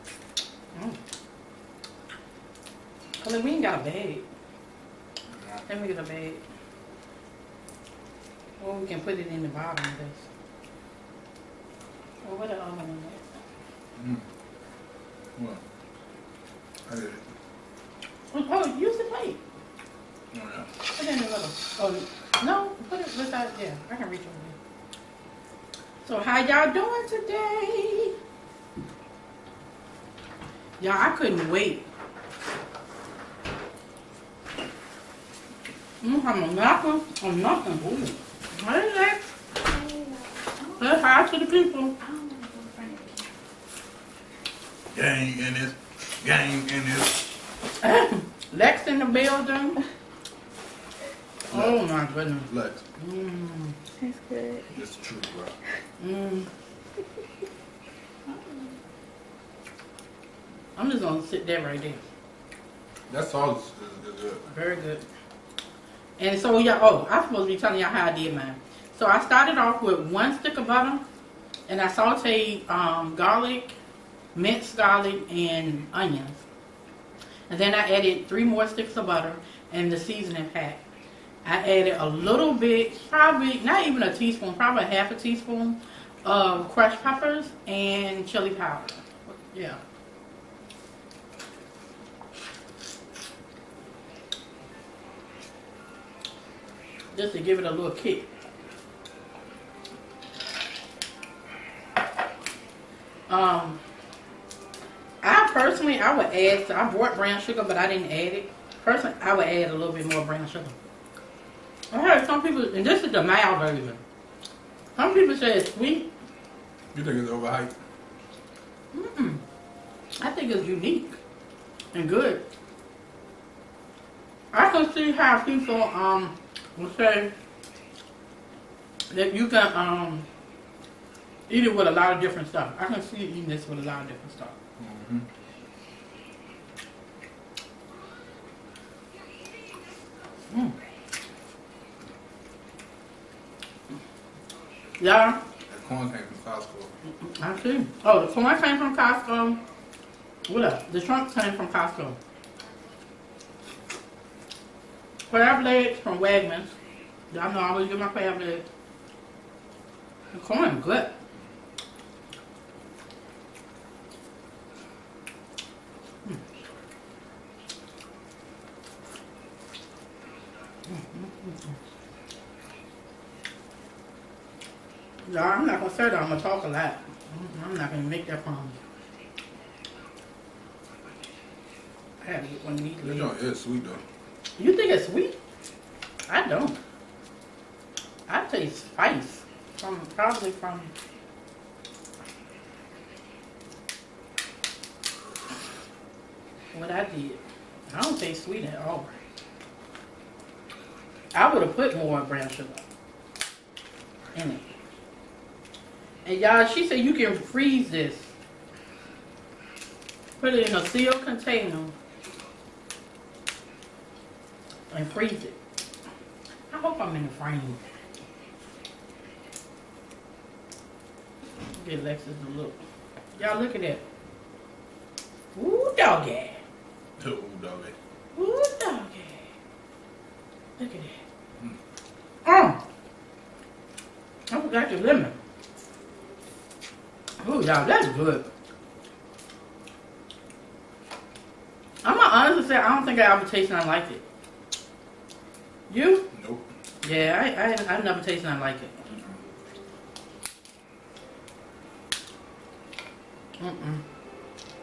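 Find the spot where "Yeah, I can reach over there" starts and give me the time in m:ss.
0:23.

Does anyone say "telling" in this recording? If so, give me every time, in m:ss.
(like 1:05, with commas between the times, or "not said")
1:07.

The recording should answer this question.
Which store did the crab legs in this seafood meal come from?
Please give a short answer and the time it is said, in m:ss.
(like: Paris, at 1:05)
Wegmans, at 2:36.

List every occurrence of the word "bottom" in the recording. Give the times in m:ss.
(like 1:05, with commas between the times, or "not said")
0:09.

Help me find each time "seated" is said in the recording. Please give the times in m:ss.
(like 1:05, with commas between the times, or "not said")
not said.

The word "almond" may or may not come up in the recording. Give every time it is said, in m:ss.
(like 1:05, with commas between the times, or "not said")
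0:12.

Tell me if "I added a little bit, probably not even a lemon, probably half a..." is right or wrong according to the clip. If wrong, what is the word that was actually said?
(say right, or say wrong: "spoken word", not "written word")
wrong: "teaspoon", not "lemon".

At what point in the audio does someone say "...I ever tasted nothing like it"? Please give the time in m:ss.
4:03.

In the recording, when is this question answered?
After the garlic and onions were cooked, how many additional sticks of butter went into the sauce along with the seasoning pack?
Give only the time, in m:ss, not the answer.
1:18.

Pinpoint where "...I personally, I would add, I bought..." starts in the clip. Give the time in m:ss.
1:45.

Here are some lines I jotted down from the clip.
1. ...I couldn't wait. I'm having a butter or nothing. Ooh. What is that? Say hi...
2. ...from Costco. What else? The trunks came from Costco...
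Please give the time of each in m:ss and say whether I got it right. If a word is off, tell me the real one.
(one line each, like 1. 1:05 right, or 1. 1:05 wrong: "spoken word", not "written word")
1. 0:30 wrong: "napper", not "butter"
2. 2:28 right.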